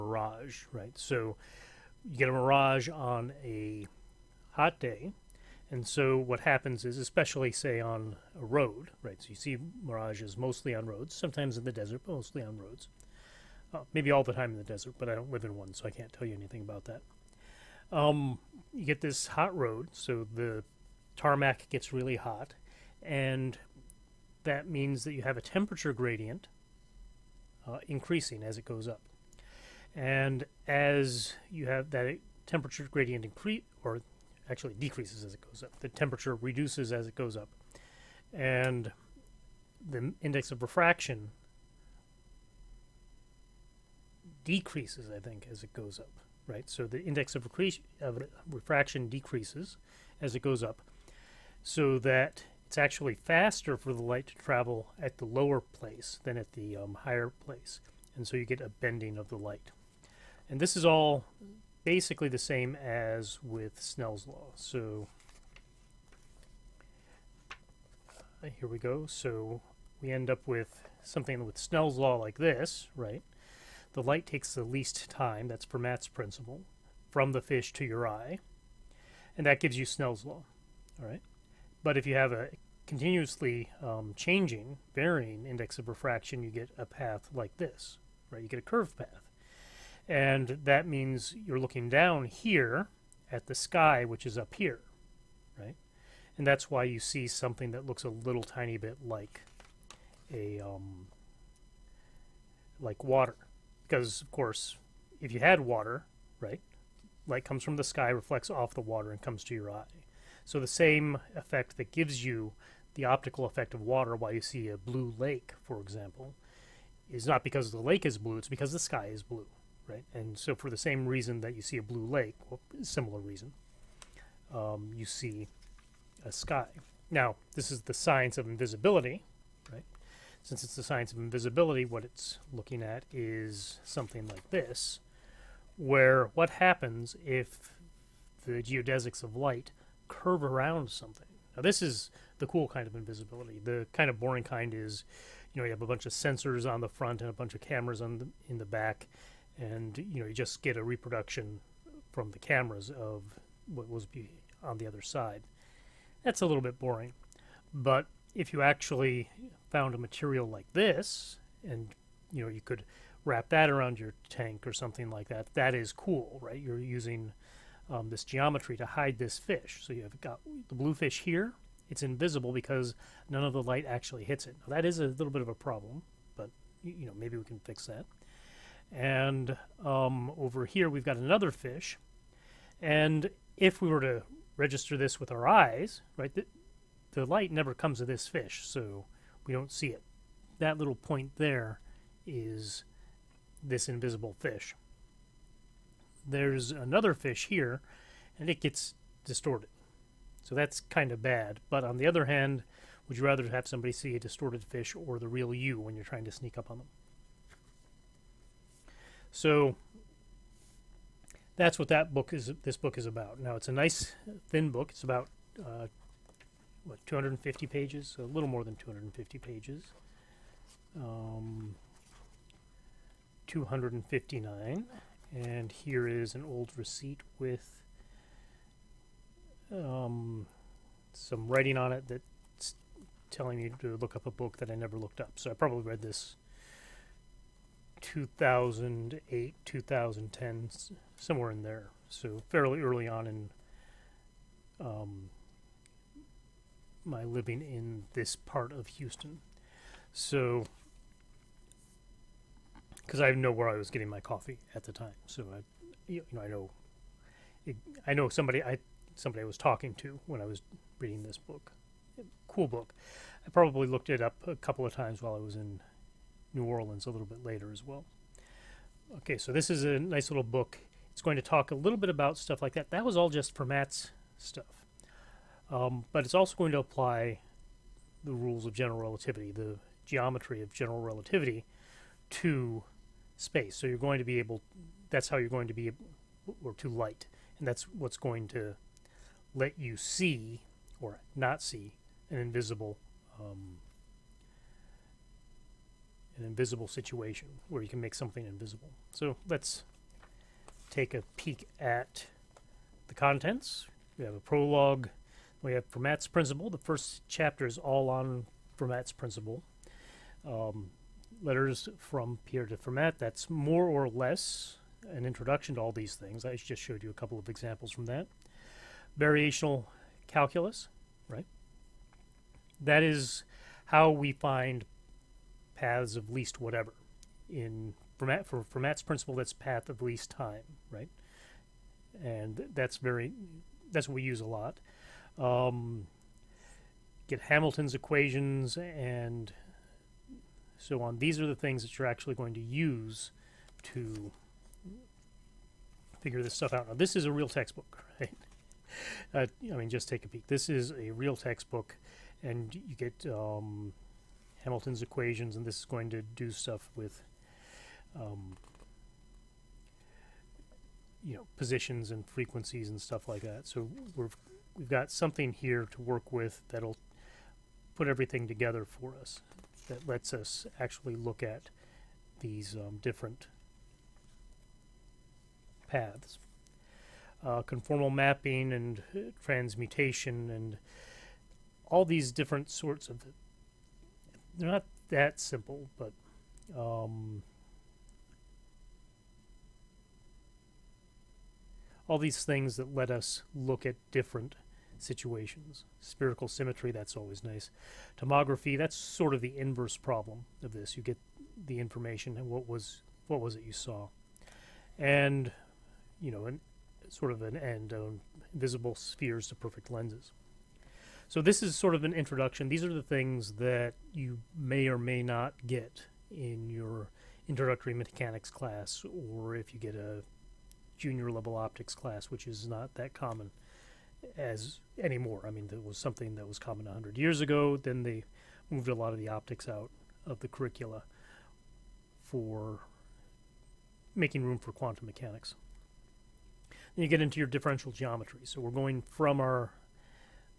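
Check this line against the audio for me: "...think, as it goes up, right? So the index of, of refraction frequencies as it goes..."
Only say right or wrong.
wrong.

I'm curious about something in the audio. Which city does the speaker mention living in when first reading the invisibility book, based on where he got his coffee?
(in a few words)
Houston.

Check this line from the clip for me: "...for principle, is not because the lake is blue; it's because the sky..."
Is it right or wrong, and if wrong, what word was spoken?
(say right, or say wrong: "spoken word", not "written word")
wrong: "example", not "principle".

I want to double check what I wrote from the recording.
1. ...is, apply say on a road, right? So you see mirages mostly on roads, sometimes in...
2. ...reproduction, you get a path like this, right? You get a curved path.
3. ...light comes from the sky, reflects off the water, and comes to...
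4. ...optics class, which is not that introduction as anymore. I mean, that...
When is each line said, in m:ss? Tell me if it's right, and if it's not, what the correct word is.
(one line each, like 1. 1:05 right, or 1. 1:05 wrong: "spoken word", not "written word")
1. 0:06 wrong: "especially", not "apply"
2. 1:25 wrong: "refraction", not "reproduction"
3. 1:47 right
4. 7:01 wrong: "common", not "introduction".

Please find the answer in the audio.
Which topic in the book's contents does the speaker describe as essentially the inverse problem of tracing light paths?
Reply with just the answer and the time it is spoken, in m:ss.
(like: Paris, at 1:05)
Tomography, at 6:38.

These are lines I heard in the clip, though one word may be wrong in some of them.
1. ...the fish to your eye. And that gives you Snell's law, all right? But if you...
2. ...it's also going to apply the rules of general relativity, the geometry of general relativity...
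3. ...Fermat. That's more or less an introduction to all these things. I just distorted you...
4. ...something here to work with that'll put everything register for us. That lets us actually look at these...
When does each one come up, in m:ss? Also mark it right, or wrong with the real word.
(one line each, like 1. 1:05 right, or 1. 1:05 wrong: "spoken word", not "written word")
1. 1:17 right
2. 4:36 right
3. 5:12 wrong: "showed", not "distorted"
4. 6:05 wrong: "together", not "register".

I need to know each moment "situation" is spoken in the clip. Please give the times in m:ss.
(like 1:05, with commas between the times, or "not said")
4:56, 6:34.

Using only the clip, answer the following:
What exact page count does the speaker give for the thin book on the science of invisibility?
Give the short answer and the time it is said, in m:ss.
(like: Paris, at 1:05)
259, at 3:43.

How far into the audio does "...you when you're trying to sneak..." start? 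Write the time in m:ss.
3:25.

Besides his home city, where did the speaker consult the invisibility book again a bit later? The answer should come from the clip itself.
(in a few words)
New Orleans.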